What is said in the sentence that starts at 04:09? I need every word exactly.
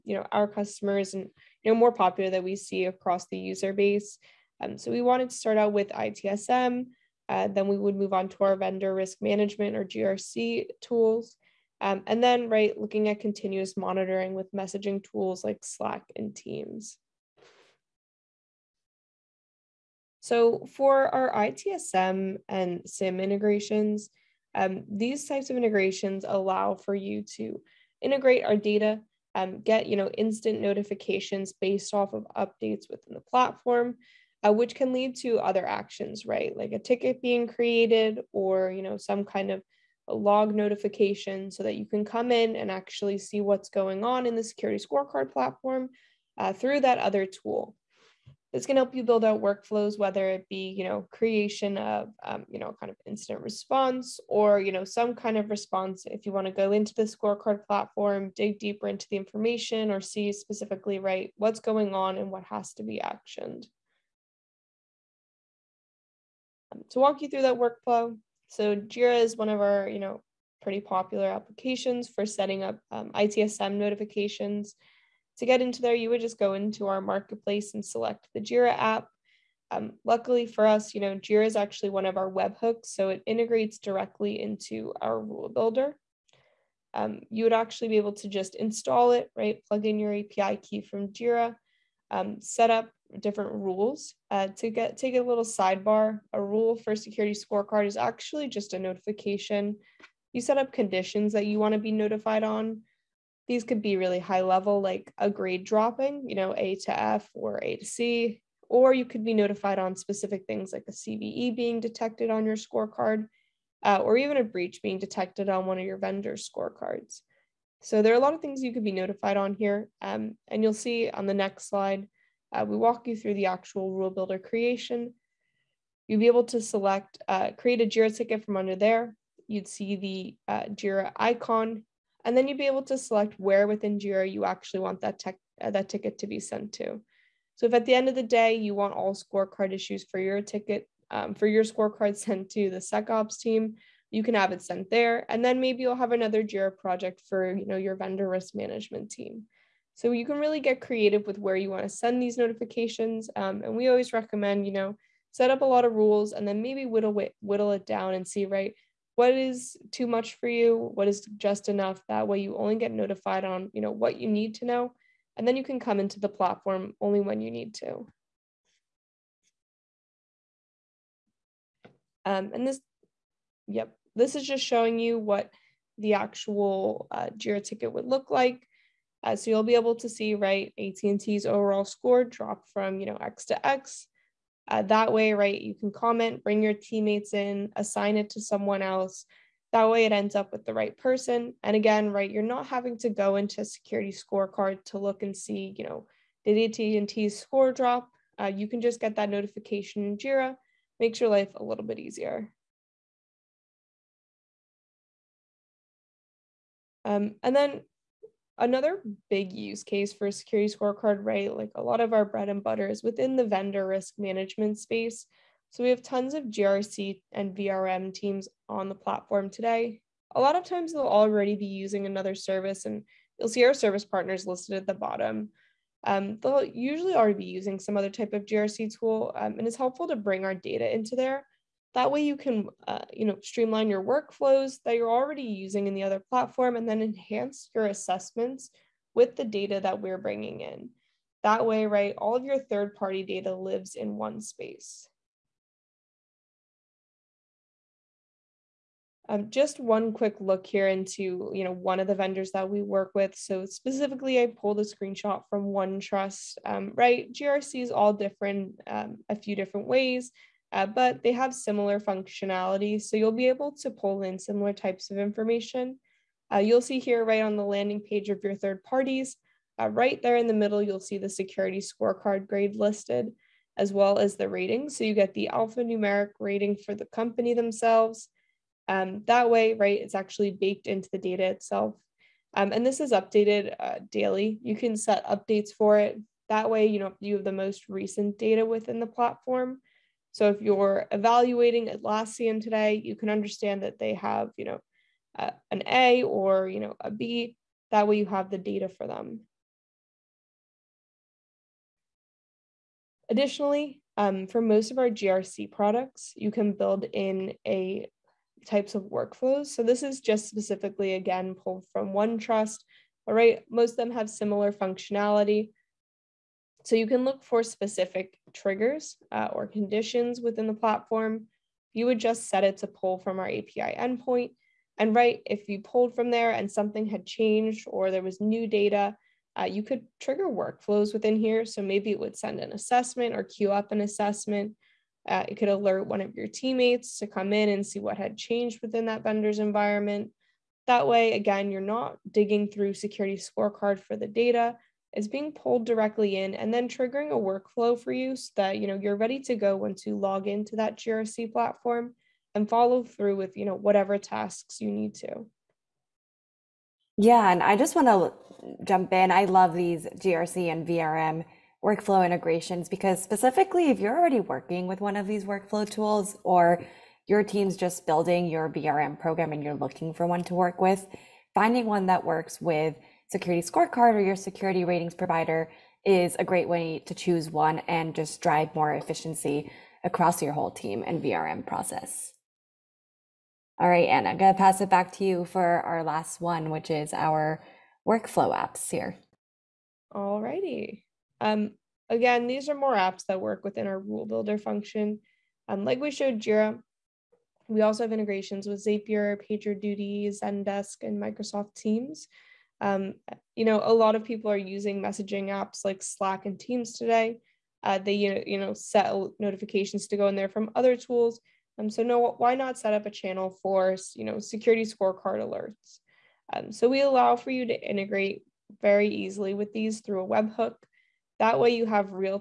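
Um, just one quick look here into you know one of the vendors that we work with.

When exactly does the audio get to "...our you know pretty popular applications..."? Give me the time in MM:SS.
01:09.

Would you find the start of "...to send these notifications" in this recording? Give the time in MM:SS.
02:31.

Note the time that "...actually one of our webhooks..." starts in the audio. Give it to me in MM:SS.
01:21.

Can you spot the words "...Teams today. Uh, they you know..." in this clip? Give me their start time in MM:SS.
06:46.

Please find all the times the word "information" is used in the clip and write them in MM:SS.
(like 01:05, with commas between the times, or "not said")
00:59, 04:25.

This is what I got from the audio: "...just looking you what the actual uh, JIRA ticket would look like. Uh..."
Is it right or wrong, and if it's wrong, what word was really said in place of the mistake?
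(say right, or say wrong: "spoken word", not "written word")
wrong: "showing", not "looking".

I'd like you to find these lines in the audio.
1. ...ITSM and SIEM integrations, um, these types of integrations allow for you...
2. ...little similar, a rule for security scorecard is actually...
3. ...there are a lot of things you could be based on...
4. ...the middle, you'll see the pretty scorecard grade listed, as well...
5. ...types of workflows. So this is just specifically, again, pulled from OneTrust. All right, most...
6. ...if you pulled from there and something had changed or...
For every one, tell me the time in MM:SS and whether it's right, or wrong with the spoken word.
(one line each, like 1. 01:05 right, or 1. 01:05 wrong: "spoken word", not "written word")
1. 00:21 right
2. 01:35 wrong: "sidebar", not "similar"
3. 01:58 wrong: "notified", not "based"
4. 04:30 wrong: "security", not "pretty"
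5. 05:08 right
6. 05:25 right.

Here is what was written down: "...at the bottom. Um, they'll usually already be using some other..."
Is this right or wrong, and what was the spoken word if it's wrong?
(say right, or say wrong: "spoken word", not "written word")
right.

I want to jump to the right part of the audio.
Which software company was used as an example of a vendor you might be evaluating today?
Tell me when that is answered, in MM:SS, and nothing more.
04:51.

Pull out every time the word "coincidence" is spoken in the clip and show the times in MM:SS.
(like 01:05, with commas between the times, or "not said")
not said.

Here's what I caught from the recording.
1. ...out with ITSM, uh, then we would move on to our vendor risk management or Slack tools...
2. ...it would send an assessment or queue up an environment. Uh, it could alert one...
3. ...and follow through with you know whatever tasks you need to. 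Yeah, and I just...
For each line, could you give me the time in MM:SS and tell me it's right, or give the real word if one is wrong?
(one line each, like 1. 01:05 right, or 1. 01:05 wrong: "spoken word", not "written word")
1. 00:05 wrong: "GRC", not "Slack"
2. 05:32 wrong: "assessment", not "environment"
3. 05:52 right.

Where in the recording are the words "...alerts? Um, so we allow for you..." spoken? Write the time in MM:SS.
06:55.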